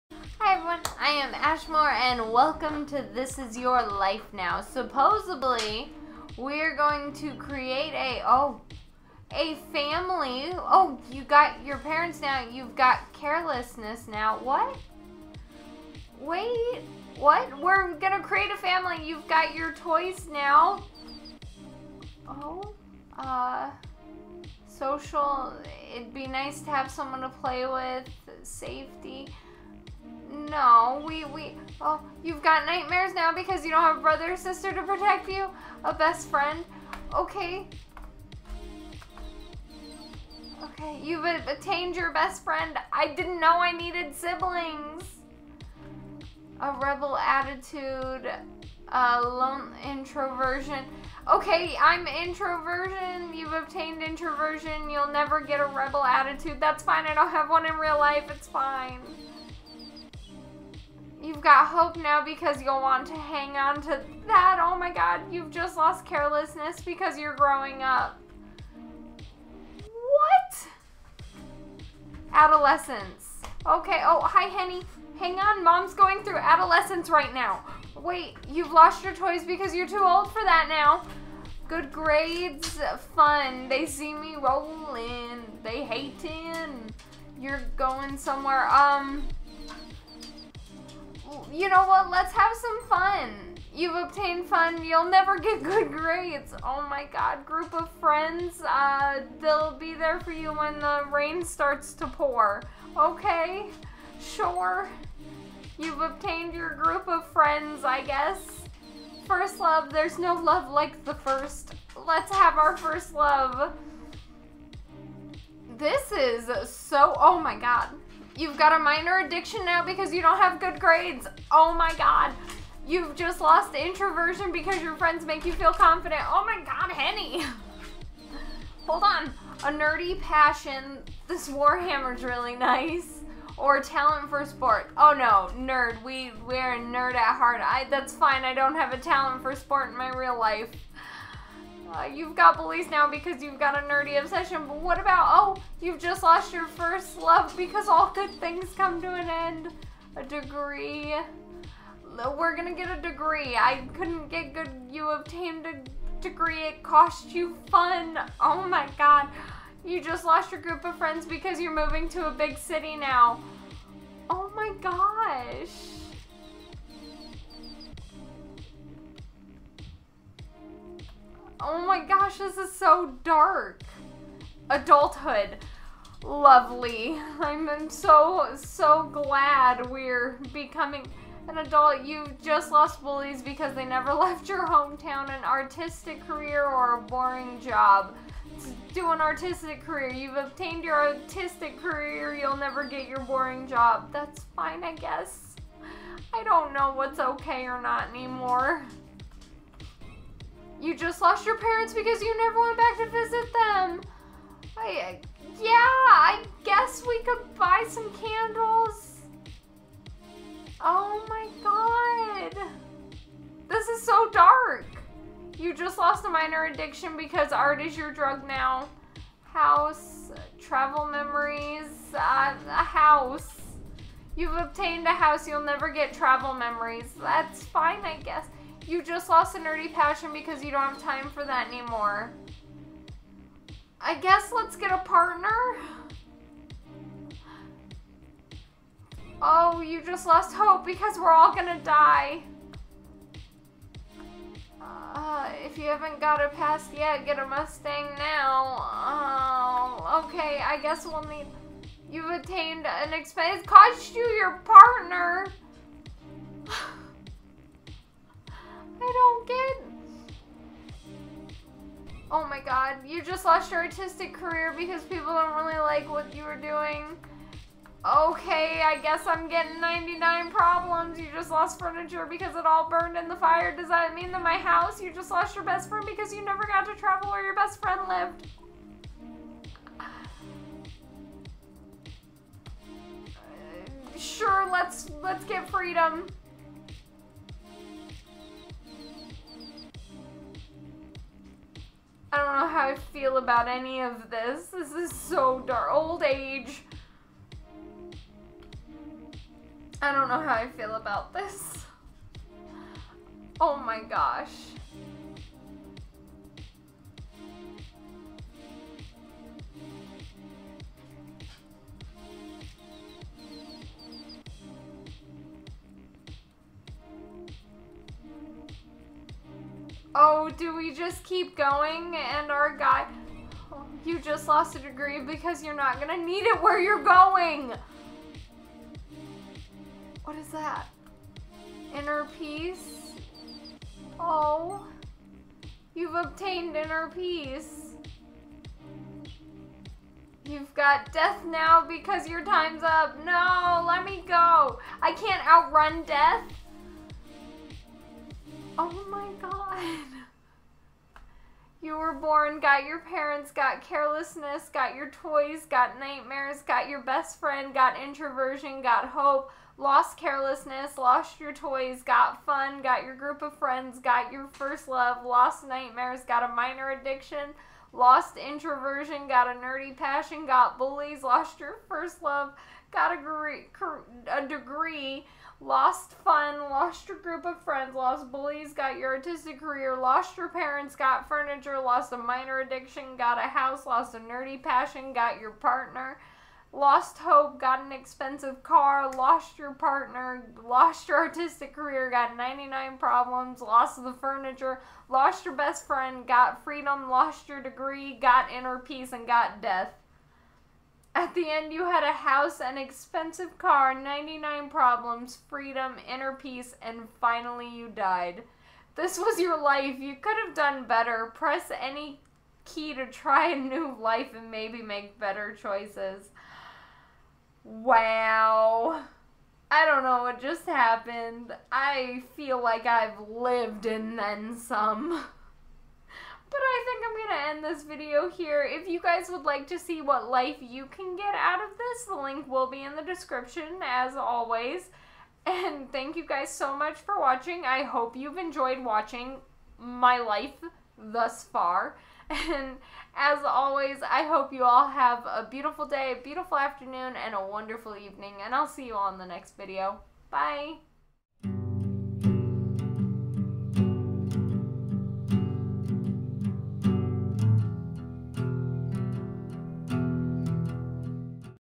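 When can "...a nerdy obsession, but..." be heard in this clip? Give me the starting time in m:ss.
2:23.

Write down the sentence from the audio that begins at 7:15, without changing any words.
And thank you guys so much for watching.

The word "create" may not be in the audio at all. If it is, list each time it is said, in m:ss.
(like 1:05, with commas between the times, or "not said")
0:07, 0:18.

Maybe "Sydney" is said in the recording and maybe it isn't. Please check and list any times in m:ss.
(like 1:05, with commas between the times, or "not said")
not said.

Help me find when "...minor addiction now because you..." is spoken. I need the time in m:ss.
1:58.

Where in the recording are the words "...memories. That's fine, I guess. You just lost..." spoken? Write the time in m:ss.
3:46.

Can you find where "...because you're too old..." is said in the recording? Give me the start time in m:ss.
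1:19.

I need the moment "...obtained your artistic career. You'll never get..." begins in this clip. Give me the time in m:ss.
3:10.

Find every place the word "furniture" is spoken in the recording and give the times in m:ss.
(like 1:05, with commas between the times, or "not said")
4:31, 6:21, 6:34.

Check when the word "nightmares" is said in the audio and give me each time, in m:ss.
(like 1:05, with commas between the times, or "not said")
0:32, 5:55, 6:05.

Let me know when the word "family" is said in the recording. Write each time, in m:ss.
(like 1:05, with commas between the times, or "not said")
0:09, 0:18.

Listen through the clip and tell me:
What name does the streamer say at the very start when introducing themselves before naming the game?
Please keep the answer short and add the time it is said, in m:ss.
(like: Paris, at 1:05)
Ashmore, at 0:01.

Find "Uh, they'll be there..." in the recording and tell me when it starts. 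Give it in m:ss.
1:38.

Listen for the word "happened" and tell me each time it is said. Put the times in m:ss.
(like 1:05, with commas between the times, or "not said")
7:00.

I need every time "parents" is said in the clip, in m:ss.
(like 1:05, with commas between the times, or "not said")
0:11, 3:21, 5:52, 6:20.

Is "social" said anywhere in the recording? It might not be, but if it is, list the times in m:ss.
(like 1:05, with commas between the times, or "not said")
0:24.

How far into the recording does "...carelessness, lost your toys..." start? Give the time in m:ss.
6:00.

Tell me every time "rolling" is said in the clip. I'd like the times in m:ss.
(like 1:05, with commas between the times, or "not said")
1:24.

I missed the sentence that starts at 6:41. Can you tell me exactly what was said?
At the end, you had a house, an expensive car, 99 problems, freedom, inner peace, and finally you died.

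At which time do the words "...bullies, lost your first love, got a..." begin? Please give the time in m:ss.
6:10.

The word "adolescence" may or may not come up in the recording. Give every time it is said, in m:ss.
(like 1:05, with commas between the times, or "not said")
1:12, 1:16.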